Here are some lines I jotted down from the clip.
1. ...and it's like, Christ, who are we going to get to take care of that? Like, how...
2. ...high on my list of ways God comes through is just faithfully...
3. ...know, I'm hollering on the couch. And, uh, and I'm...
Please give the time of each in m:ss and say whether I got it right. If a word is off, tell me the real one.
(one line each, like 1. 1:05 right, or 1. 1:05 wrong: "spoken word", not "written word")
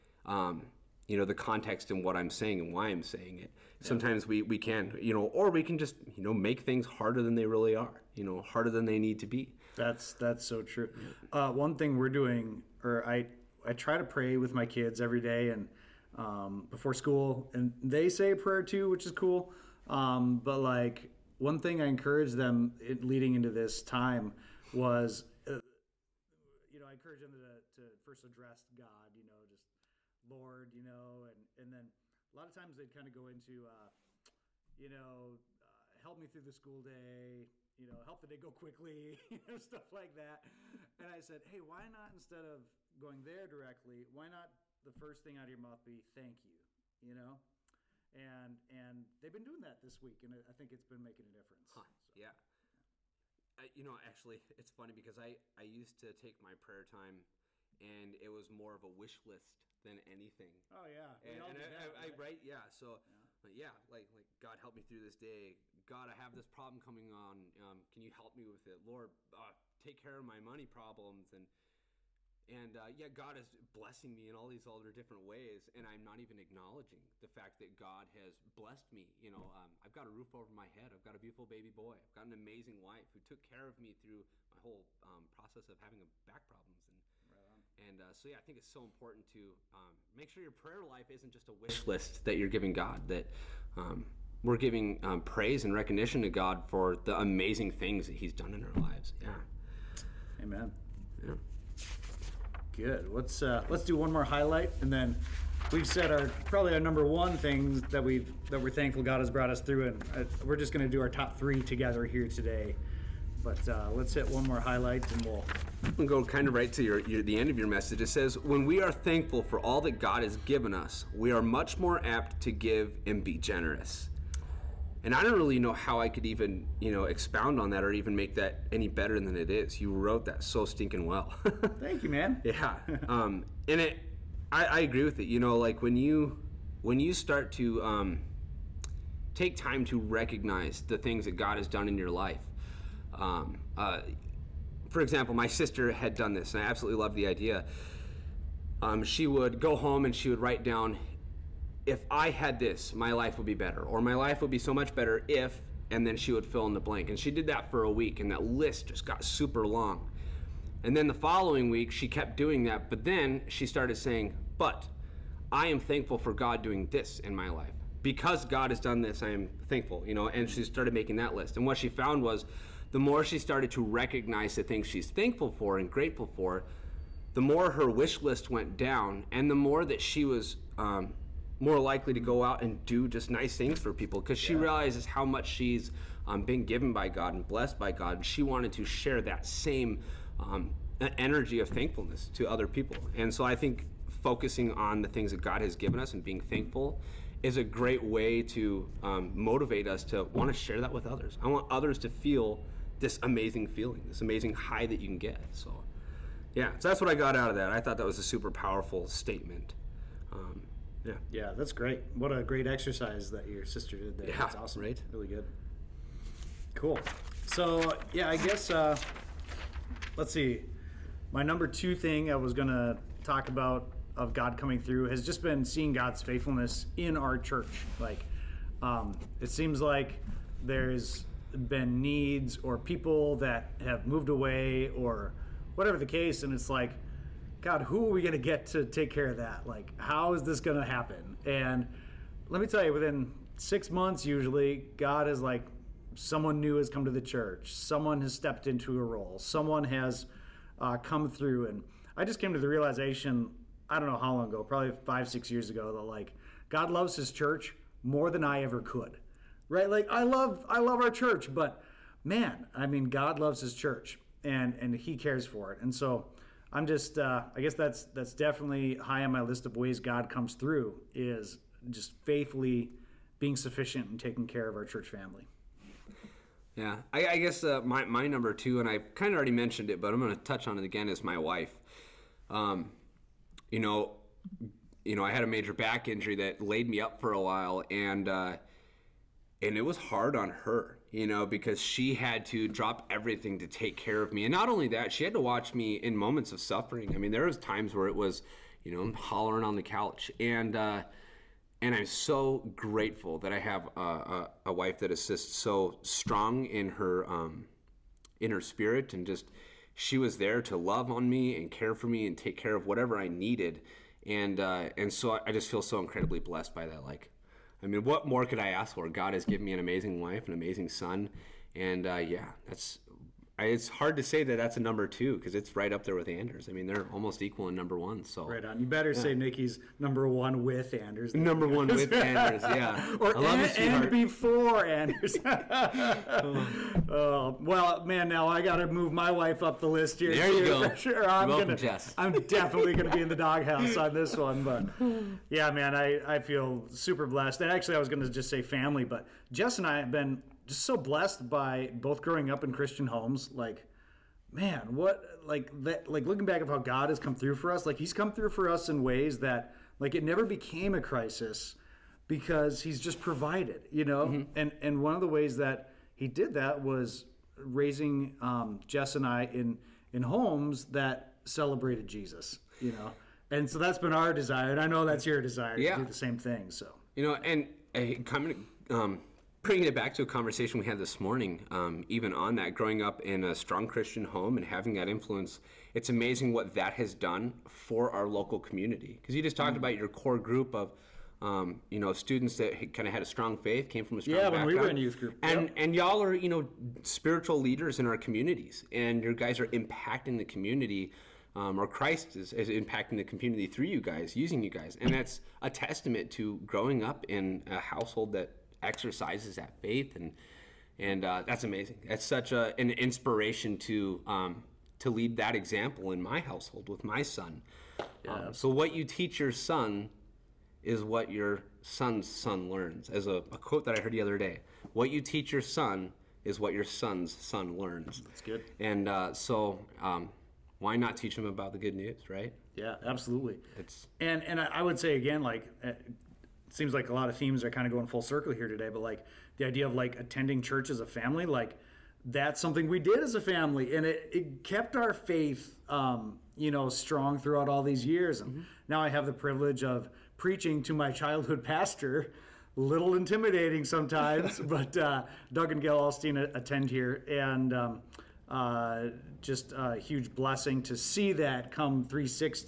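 1. 3:56 wrong: "God", not "Christ"
2. 4:28 right
3. 4:58 right.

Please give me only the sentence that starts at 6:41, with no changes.
Um, or Christ is, is, impacting the community through you guys, using you guys.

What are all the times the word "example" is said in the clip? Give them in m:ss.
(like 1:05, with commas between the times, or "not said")
2:24, 6:55.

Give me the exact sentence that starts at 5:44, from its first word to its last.
But yeah, man, I I feel super blessed.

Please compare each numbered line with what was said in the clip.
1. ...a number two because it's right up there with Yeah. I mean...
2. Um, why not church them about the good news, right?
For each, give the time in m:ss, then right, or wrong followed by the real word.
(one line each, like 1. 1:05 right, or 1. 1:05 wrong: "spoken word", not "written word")
1. 5:24 wrong: "Anders", not "Yeah"
2. 7:10 wrong: "teach", not "church".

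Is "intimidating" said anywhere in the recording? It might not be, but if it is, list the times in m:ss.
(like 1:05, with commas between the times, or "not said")
7:33.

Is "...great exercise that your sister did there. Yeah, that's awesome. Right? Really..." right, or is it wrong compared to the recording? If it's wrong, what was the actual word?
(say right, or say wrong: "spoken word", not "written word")
right.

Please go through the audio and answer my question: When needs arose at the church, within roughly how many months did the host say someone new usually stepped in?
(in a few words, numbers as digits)
six months.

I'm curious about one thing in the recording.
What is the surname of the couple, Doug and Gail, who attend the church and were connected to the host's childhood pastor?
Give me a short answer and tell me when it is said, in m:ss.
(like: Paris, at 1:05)
Alstein, at 7:35.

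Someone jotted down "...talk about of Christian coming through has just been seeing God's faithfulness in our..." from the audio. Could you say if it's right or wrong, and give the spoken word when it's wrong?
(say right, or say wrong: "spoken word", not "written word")
wrong: "God", not "Christian".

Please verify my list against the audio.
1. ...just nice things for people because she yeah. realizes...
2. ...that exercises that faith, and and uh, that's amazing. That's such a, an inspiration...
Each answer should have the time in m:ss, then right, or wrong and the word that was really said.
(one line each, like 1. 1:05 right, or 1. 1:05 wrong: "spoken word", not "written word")
1. 3:03 right
2. 6:48 right.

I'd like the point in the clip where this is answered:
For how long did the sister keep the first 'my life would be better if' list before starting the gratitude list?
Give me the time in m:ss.
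2:37.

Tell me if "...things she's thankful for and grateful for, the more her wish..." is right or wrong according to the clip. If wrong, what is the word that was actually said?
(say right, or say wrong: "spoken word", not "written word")
right.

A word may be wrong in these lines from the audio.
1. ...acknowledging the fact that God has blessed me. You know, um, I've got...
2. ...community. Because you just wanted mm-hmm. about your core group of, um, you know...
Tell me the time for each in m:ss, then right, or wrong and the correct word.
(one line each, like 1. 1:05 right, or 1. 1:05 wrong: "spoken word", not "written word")
1. 1:16 right
2. 6:28 wrong: "talked", not "wanted".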